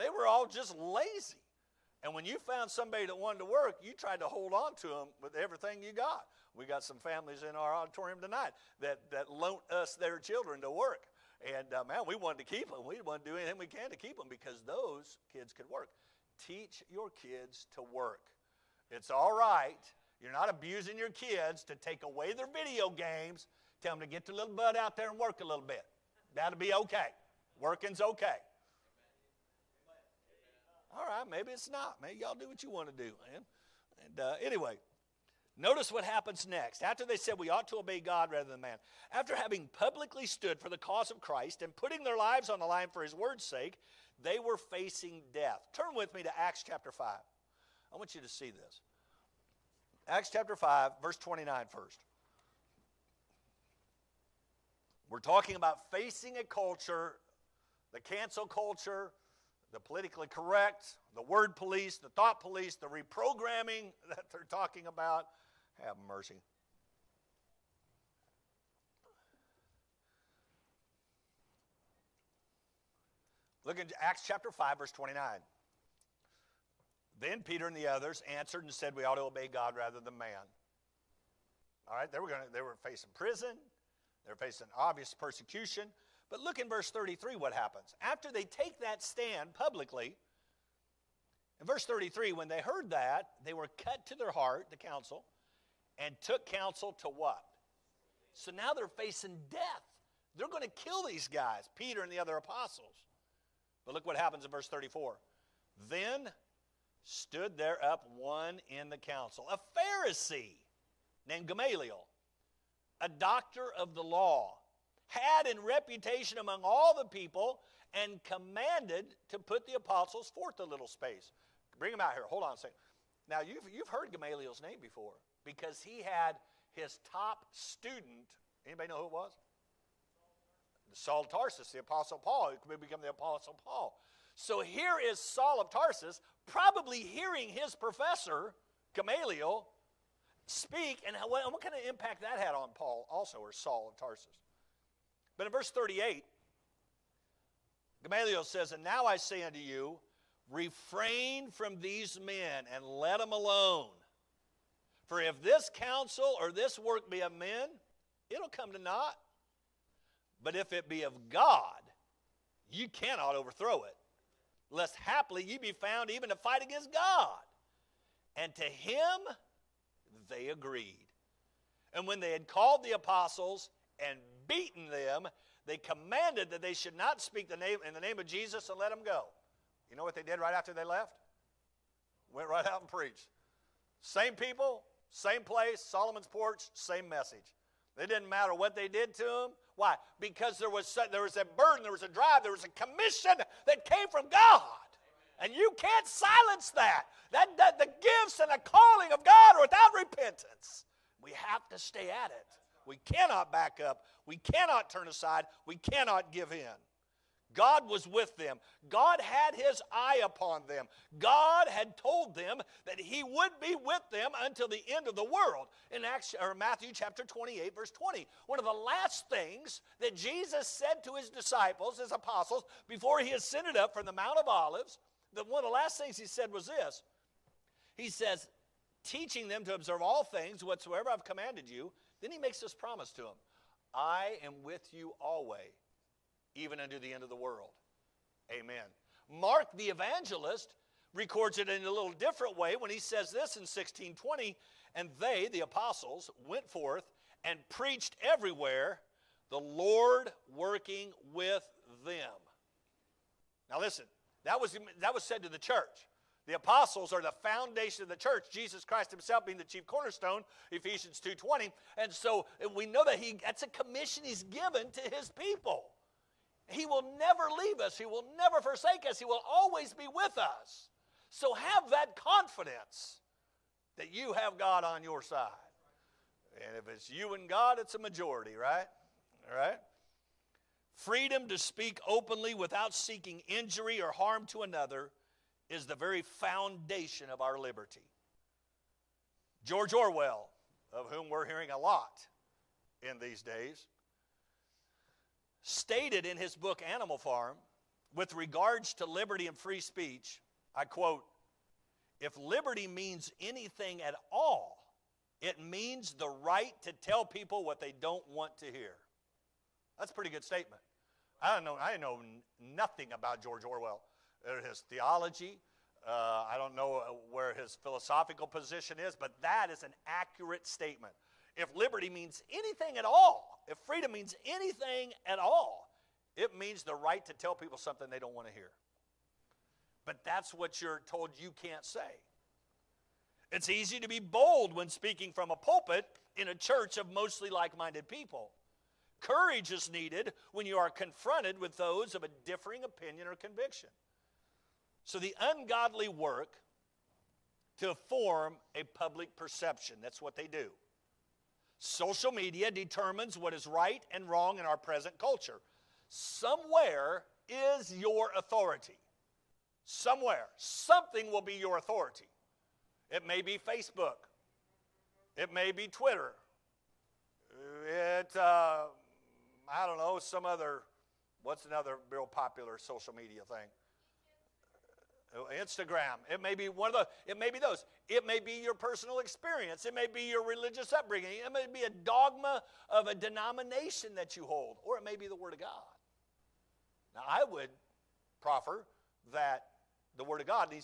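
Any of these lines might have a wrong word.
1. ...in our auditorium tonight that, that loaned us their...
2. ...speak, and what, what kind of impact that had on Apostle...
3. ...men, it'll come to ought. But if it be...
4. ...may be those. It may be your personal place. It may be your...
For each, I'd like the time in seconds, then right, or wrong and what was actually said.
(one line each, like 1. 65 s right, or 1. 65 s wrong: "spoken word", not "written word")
1. 7 s right
2. 140 s wrong: "Paul", not "Apostle"
3. 157 s wrong: "naught", not "ought"
4. 377 s wrong: "experience", not "place".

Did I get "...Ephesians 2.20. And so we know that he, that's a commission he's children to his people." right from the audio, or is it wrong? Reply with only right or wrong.
wrong.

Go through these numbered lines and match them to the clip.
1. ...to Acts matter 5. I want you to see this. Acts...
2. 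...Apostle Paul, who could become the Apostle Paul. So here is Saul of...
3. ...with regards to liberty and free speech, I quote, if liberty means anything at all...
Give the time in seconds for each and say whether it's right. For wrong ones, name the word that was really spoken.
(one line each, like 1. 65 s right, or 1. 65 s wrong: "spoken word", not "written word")
1. 46 s wrong: "chapter", not "matter"
2. 131 s right
3. 298 s right.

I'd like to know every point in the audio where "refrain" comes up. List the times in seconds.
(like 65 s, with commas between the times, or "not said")
150 s.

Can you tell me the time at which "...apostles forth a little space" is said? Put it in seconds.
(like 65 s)
119 s.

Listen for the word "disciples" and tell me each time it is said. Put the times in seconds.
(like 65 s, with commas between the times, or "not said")
221 s.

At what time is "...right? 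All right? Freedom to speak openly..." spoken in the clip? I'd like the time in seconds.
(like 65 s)
278 s.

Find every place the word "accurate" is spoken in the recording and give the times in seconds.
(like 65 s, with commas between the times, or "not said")
320 s.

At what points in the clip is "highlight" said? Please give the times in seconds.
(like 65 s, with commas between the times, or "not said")
not said.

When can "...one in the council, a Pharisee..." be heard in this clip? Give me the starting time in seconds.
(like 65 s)
108 s.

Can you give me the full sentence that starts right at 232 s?
Then he makes this promise to them I am with you always, even unto the end of the world.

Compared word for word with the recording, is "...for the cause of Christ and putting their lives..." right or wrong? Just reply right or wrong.
right.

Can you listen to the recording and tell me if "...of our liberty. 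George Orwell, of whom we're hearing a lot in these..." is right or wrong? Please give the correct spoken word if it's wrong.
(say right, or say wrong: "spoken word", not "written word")
right.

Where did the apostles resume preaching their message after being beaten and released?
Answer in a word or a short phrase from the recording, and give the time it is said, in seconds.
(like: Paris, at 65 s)
Solomon's porch, at 185 s.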